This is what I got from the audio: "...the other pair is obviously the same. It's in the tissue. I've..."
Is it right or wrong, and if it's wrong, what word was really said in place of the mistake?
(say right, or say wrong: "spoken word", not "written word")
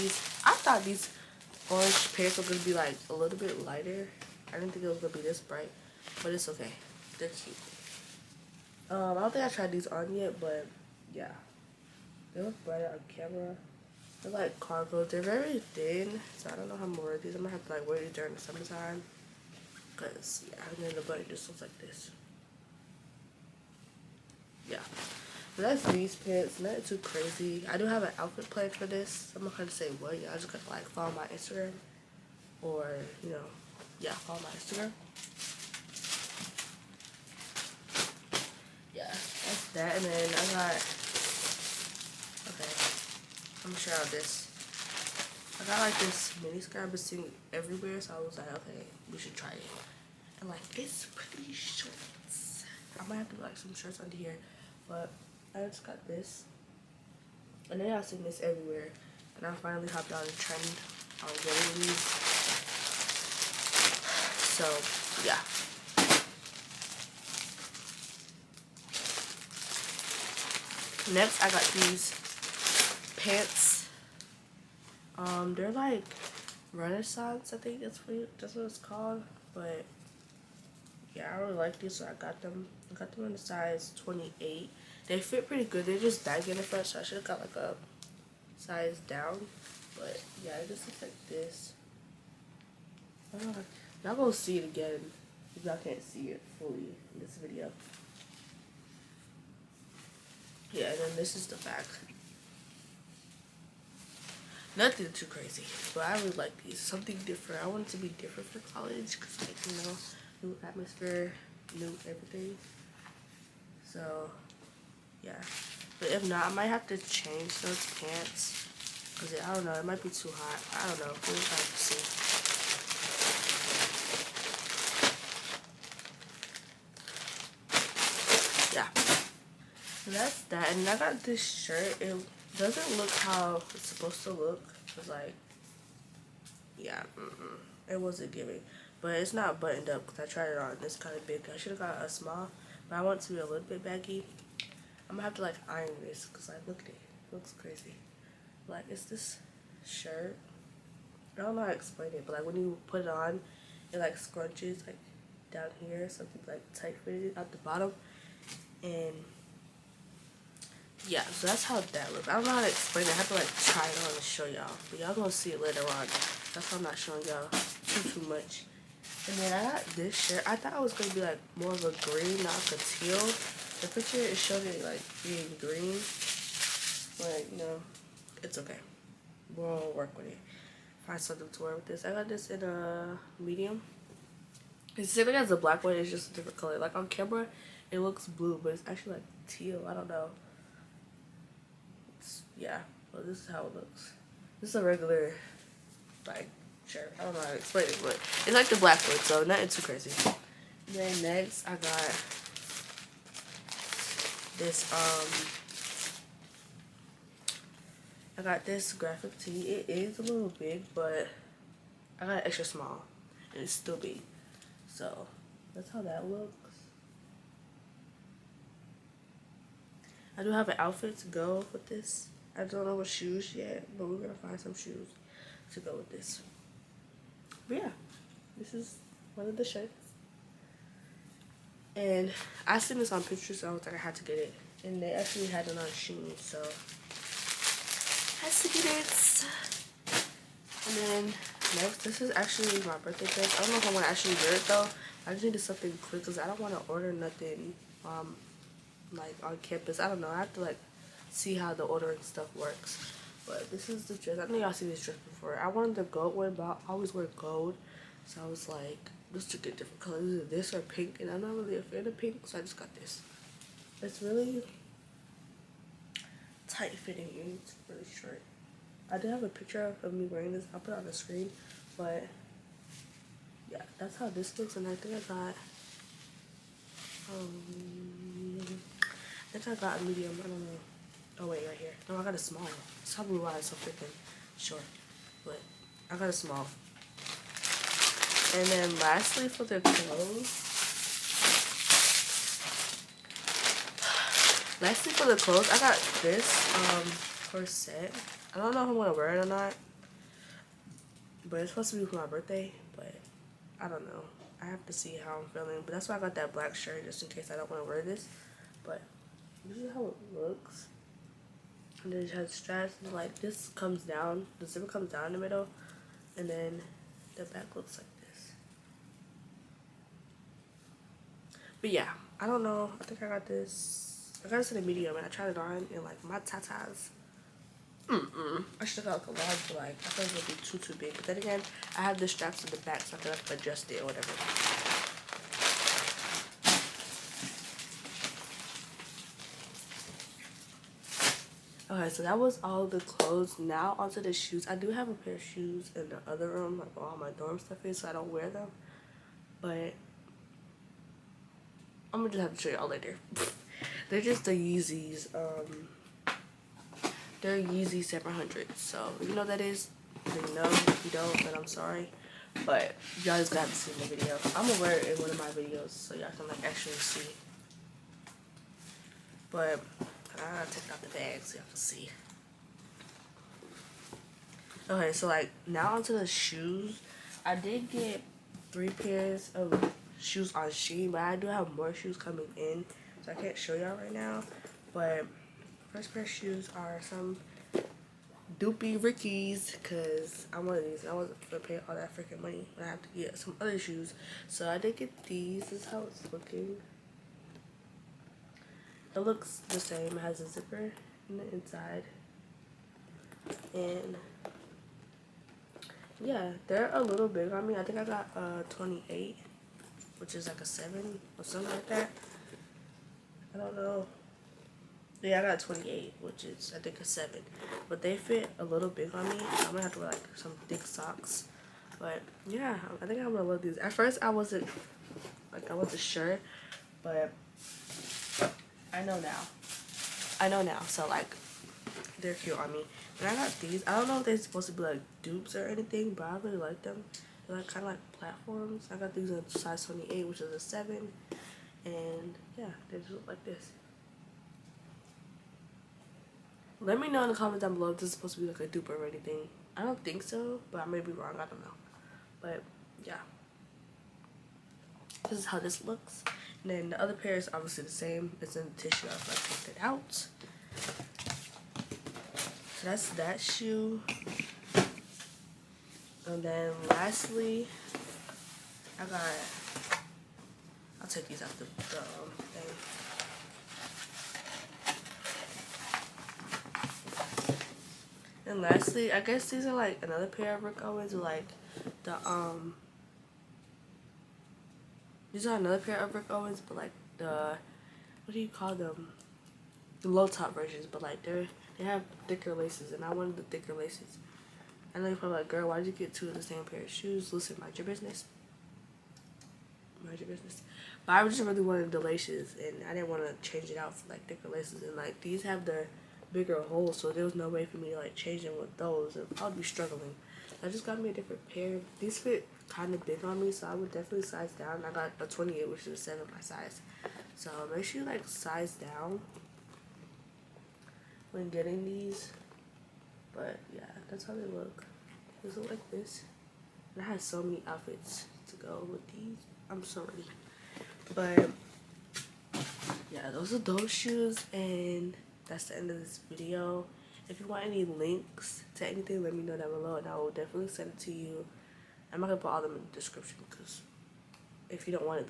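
right.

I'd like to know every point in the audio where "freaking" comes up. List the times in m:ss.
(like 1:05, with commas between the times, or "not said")
4:43, 6:32.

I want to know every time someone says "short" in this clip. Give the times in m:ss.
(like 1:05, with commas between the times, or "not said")
0:51, 4:28, 4:44.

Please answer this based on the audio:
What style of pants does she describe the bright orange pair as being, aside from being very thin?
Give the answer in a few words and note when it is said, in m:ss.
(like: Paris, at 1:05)
Cargo, at 0:14.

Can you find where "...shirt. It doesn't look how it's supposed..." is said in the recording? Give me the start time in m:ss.
2:11.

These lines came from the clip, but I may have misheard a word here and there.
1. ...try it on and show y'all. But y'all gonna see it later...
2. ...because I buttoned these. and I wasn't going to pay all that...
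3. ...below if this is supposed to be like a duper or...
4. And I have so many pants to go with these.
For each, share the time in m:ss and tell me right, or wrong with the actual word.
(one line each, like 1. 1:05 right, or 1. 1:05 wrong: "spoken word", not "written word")
1. 2:43 right
2. 6:29 wrong: "wanted", not "buttoned"
3. 7:27 right
4. 8:46 wrong: "outfits", not "pants".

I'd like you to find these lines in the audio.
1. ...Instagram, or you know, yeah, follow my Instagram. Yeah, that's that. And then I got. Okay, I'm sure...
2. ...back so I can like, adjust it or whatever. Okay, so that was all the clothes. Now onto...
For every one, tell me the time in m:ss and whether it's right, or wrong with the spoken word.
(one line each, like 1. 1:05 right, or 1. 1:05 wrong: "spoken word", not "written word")
1. 0:31 right
2. 5:32 right.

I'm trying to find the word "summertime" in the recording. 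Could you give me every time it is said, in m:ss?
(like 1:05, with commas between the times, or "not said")
0:18.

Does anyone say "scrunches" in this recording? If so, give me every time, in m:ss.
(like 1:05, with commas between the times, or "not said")
2:34.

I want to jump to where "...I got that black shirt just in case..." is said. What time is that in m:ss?
5:06.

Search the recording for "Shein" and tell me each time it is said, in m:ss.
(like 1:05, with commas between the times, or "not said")
3:55, 6:20.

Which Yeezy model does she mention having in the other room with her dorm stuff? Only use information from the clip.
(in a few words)
Yeezy 700.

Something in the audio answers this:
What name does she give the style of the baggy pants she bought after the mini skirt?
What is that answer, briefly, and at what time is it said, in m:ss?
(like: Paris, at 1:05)
Renaissance, at 1:16.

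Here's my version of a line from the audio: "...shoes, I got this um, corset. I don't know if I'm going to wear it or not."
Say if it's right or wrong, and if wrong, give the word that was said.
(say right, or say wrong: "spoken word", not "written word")
wrong: "clothes", not "shoes".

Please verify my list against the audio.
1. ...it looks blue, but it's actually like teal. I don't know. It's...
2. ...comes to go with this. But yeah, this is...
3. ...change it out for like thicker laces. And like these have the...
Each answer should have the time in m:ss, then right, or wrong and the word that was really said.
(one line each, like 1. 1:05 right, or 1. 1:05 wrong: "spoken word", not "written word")
1. 3:07 right
2. 3:44 wrong: "shoes", not "comes"
3. 8:23 right.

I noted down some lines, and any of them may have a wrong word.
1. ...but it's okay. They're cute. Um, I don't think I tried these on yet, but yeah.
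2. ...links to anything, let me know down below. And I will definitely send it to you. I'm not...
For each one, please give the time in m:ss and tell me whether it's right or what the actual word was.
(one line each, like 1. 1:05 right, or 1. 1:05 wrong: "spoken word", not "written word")
1. 0:06 right
2. 8:57 right.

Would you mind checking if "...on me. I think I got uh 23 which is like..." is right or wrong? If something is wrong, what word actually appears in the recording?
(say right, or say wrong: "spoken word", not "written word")
wrong: "28", not "23".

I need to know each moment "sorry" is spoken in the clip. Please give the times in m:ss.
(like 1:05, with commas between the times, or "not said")
6:01, 8:49.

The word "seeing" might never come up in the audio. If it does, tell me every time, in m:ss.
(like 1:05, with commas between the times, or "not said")
0:46.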